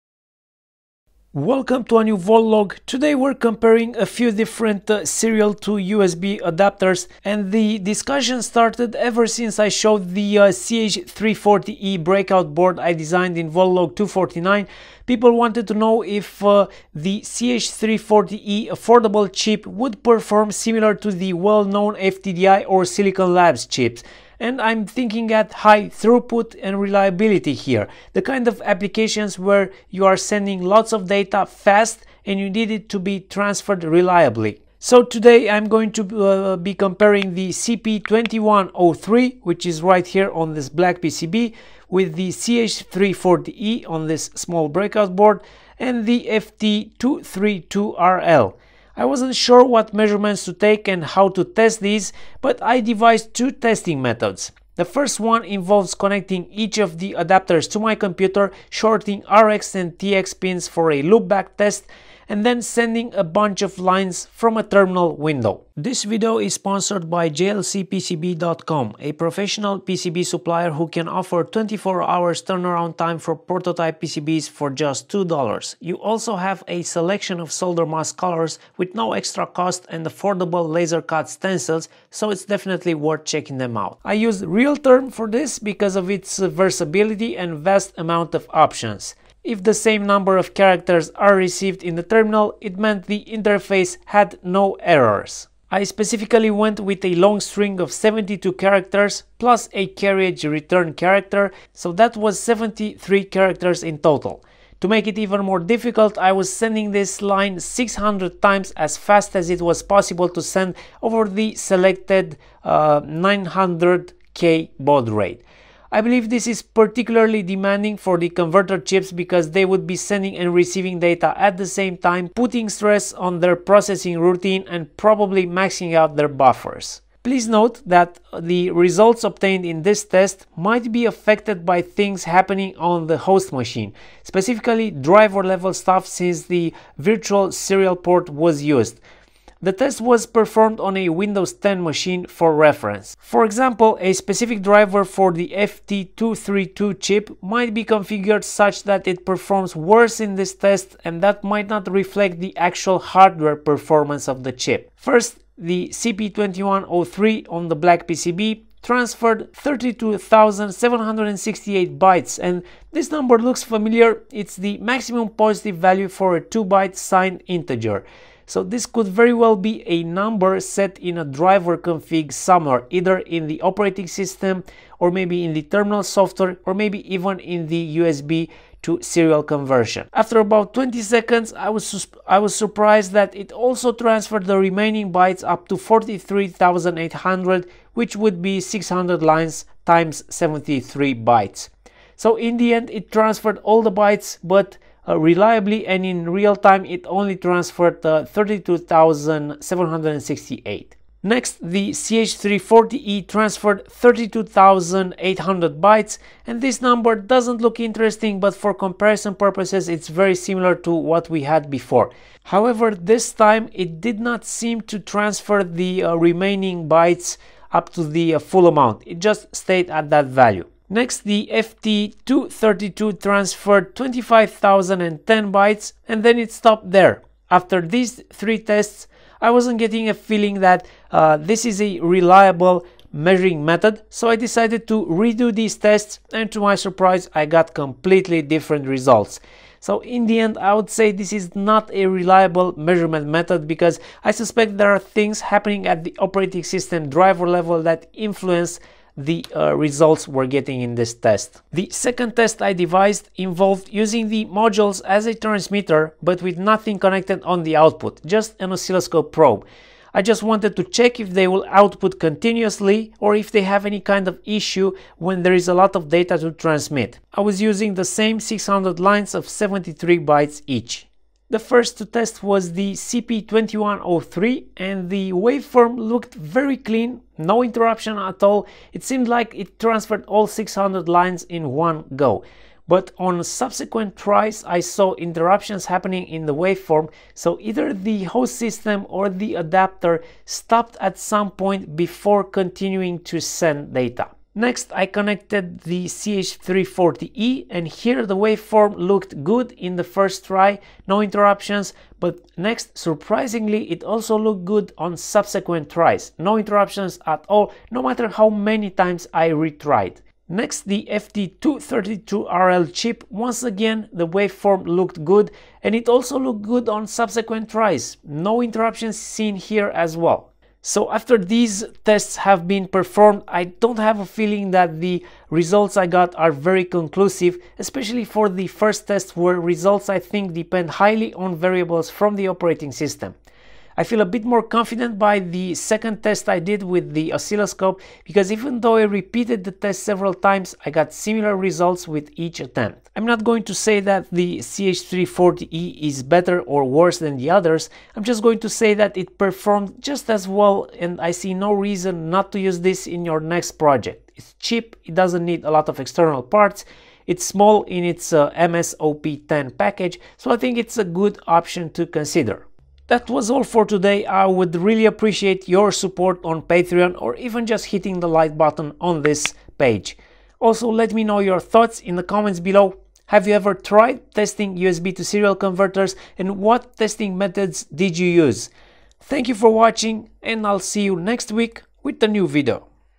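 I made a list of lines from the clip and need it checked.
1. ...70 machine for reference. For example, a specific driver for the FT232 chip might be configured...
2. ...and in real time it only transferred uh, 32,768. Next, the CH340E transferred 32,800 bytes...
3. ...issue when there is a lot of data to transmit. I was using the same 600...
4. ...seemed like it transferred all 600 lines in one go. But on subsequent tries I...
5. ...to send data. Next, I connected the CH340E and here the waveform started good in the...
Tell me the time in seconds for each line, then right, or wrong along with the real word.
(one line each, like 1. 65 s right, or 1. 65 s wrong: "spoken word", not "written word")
1. 141 s wrong: "10", not "70"
2. 195 s right
3. 264 s right
4. 279 s right
5. 293 s wrong: "looked", not "started".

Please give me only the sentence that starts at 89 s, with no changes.
If the same number of characters are received in the terminal, it meant the interface had no errors.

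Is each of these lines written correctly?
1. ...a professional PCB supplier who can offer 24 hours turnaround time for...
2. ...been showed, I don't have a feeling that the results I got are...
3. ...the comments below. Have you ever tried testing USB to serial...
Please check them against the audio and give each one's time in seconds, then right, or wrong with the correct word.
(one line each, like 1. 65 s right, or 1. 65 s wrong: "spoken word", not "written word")
1. 68 s right
2. 322 s wrong: "performed", not "showed"
3. 372 s right.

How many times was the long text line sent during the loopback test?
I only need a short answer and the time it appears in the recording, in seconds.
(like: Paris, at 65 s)
600, at 107 s.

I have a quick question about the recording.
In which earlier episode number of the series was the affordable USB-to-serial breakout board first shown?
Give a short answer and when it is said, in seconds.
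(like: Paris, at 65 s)
249, at 13 s.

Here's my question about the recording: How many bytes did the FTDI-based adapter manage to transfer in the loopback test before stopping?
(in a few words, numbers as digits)
25,010.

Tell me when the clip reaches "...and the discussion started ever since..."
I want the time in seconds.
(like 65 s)
7 s.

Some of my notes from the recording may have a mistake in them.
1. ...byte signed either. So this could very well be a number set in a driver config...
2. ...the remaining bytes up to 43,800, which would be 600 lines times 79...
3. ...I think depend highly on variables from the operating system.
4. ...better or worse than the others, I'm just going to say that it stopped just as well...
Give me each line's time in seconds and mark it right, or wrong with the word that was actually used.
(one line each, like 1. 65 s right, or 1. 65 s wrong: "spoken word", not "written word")
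1. 166 s wrong: "integer", not "either"
2. 184 s wrong: "73", not "79"
3. 330 s right
4. 346 s wrong: "performed", not "stopped".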